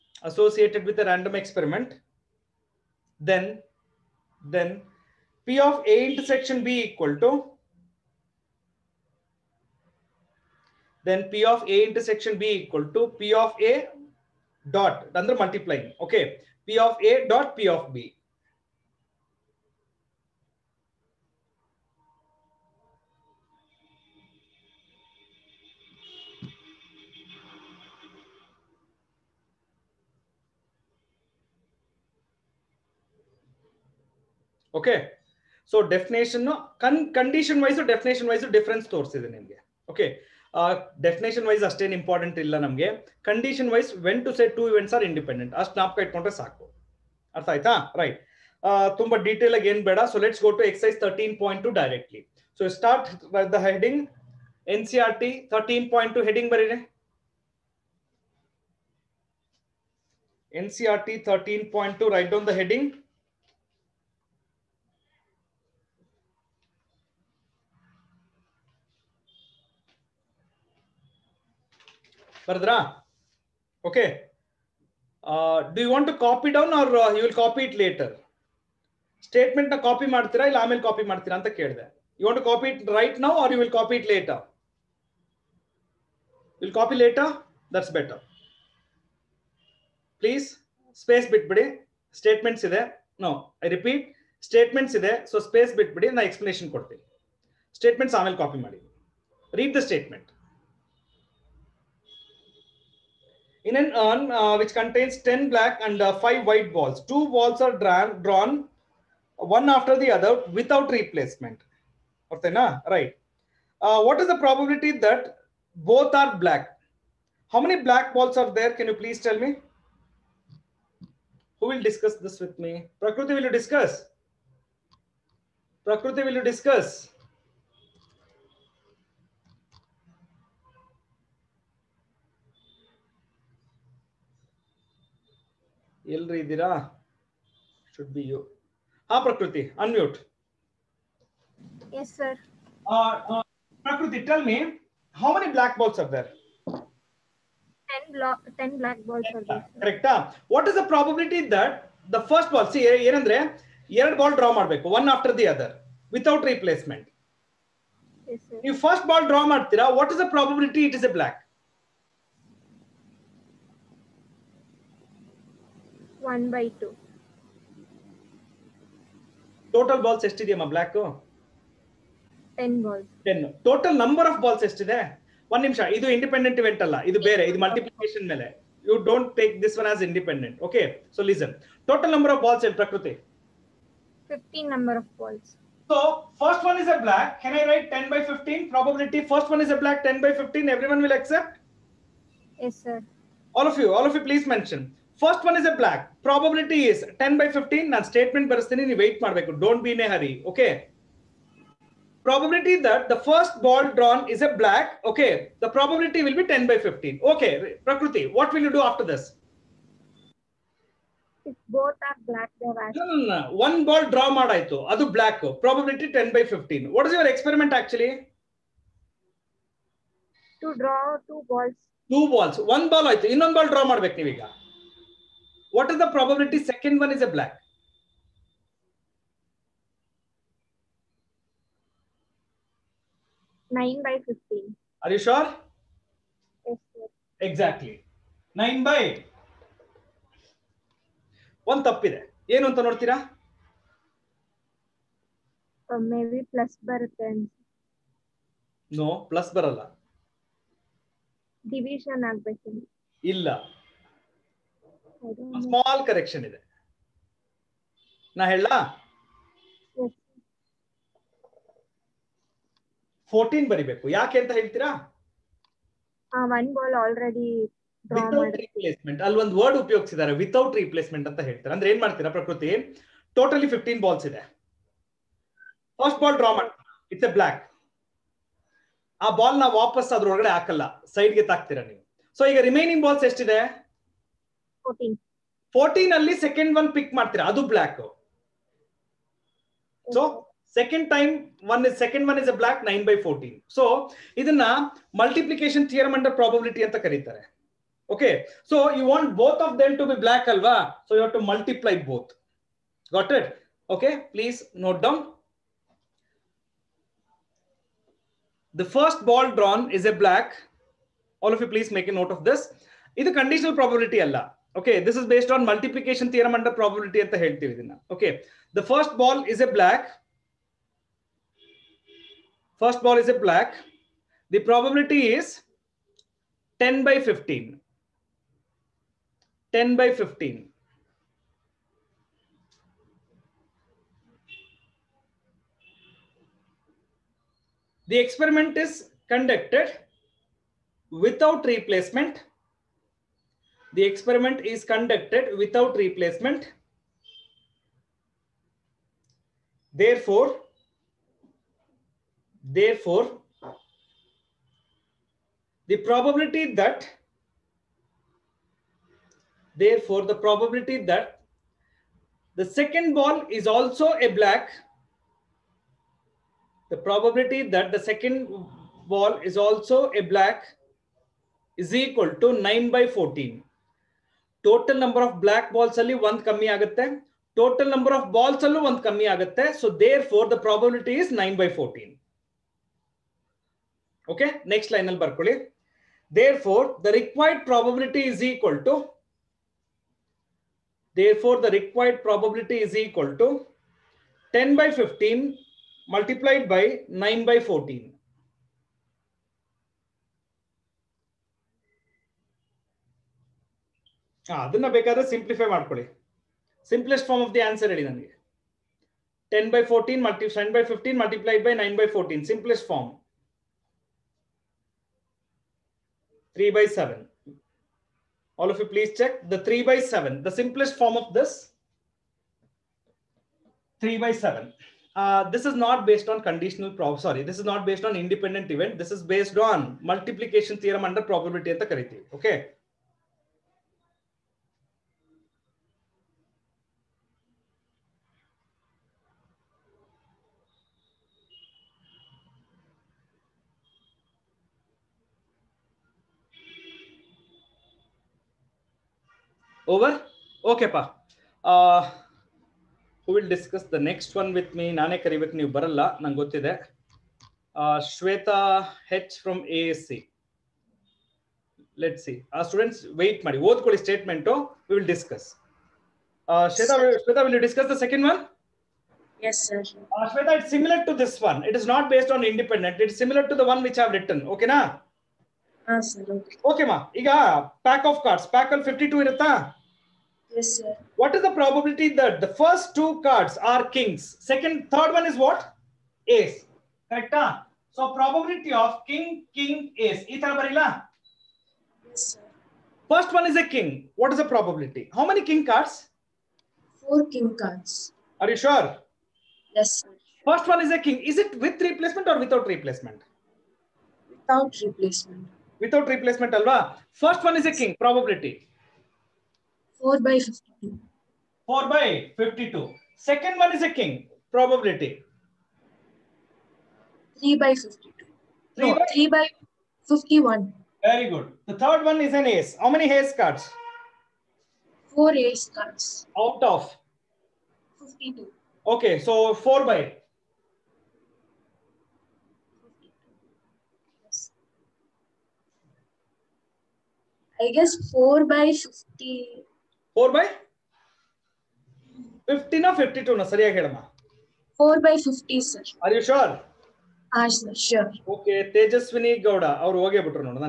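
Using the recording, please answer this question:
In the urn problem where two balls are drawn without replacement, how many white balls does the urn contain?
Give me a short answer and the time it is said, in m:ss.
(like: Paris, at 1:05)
5, at 1:46.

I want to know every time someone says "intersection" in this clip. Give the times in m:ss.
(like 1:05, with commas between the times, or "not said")
0:06, 0:11.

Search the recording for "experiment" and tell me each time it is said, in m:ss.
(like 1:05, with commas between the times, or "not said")
0:01, 3:37, 5:38, 5:44.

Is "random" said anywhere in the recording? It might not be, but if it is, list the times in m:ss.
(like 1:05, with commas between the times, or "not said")
0:01.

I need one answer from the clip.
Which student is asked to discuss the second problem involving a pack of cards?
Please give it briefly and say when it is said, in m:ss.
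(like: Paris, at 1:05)
Shweta, at 7:38.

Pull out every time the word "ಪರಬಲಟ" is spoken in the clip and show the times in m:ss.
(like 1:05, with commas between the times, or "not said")
2:40, 4:56, 5:13.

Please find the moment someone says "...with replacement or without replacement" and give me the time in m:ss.
8:21.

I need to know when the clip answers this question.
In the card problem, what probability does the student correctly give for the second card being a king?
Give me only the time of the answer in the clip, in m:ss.
8:39.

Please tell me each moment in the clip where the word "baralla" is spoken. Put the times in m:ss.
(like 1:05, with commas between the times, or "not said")
4:09.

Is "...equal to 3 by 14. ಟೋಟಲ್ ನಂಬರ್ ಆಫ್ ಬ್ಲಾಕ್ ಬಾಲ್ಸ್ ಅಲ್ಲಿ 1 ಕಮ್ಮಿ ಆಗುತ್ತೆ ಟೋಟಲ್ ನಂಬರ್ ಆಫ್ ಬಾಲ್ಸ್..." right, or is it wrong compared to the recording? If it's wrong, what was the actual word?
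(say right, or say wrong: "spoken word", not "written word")
wrong: "9", not "3".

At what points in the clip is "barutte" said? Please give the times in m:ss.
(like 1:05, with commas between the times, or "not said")
4:06.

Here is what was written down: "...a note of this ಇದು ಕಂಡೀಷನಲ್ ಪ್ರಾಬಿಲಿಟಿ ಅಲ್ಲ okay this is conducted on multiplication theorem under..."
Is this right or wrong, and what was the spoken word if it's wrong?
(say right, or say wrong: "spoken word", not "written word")
wrong: "based", not "conducted".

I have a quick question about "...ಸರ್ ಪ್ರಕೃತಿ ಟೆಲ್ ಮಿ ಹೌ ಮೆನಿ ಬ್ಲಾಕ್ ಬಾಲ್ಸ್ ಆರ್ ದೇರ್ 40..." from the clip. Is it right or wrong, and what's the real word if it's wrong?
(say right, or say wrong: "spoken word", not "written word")
wrong: "10", not "40".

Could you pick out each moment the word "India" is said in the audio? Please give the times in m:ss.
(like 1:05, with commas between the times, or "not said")
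0:39.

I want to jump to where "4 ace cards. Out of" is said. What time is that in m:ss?
8:45.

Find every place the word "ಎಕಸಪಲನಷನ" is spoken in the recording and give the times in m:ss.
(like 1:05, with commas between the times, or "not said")
1:36.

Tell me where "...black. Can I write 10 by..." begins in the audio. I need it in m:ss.
3:07.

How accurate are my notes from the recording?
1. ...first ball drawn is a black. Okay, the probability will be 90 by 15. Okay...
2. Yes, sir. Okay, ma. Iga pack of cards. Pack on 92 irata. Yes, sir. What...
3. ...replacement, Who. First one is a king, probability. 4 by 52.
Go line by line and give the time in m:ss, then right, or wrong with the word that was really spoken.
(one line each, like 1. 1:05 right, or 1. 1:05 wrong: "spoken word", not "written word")
1. 3:23 wrong: "10", not "90"
2. 7:55 wrong: "52", not "92"
3. 8:26 wrong: "Alva", not "Who".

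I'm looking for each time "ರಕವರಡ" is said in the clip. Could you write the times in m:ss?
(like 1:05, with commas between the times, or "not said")
6:27, 6:31.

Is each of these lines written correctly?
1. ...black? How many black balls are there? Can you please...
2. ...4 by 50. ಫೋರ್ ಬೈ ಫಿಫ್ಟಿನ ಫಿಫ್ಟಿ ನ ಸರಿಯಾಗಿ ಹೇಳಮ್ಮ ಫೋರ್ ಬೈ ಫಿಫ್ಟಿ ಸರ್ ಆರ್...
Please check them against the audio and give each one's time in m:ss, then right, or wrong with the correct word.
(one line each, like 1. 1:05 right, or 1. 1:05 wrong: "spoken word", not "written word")
1. 1:56 right
2. 8:58 right.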